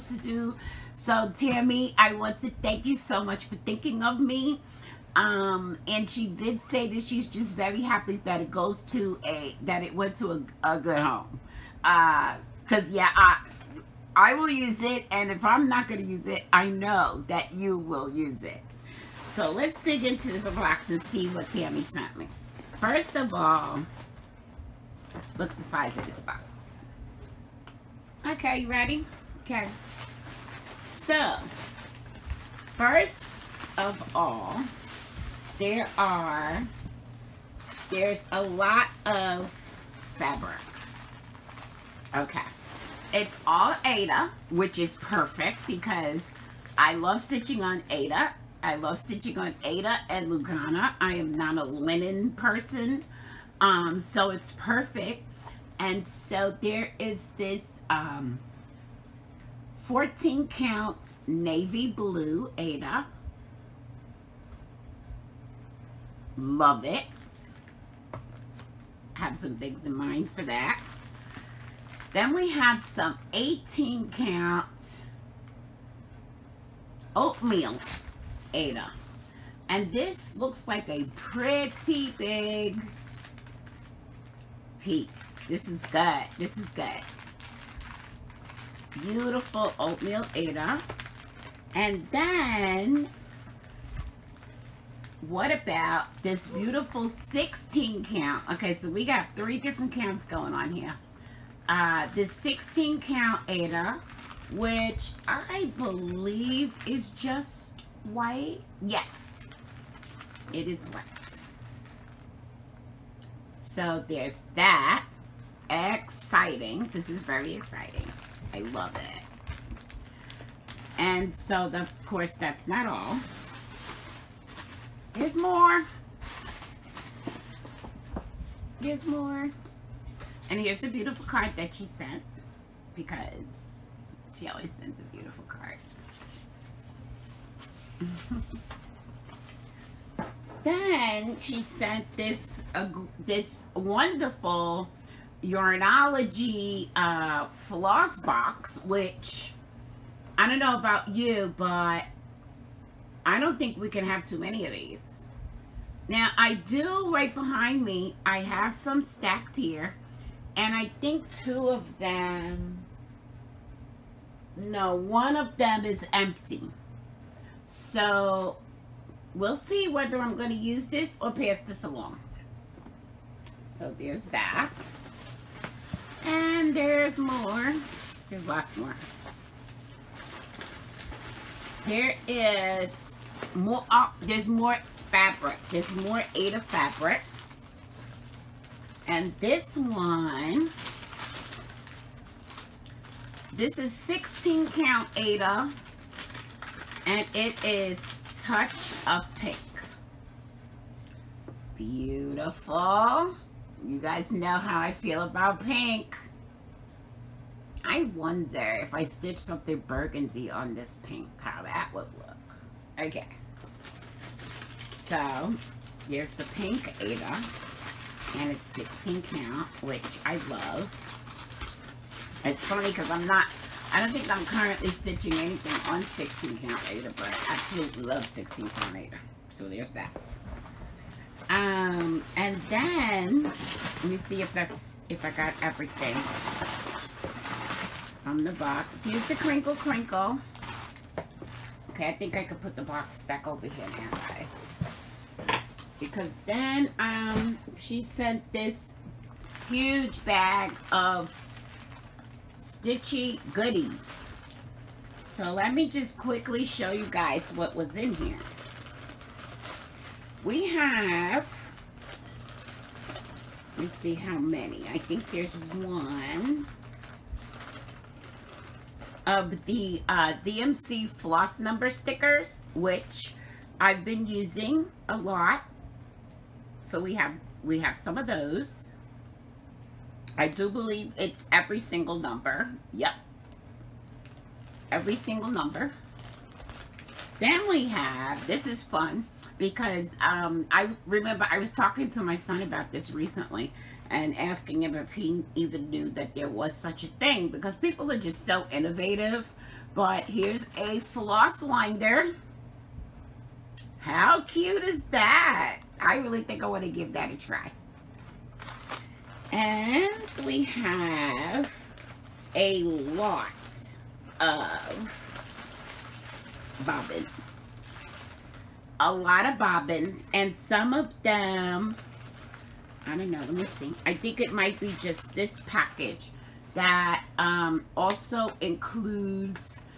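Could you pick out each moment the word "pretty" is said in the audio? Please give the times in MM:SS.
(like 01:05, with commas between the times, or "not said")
01:21.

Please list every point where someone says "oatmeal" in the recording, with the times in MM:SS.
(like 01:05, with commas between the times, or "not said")
01:17, 01:29.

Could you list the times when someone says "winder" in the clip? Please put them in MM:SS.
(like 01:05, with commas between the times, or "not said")
05:01.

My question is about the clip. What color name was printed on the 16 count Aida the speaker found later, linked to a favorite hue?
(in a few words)
Touch of Pink.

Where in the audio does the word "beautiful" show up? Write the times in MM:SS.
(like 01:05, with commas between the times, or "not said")
01:28, 01:36, 02:10, 02:15, 03:21.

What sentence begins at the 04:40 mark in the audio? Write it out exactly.
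I do believe it's every single number.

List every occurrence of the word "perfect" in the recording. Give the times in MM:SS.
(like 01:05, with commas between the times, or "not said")
00:45, 00:54.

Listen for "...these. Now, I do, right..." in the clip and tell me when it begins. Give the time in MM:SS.
02:34.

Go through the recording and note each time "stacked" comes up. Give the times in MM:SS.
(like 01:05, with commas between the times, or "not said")
02:39.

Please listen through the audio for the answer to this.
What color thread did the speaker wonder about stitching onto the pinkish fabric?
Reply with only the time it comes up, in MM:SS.
03:29.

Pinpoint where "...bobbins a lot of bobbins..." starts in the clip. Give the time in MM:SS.
05:16.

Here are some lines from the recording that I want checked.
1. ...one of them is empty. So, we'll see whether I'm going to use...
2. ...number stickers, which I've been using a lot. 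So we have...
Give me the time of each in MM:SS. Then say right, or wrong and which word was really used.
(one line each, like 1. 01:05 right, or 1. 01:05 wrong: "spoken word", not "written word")
1. 02:44 right
2. 04:31 right.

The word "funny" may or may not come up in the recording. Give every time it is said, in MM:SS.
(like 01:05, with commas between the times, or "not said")
03:42.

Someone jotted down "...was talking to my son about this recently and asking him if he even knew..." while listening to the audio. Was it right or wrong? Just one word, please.
right.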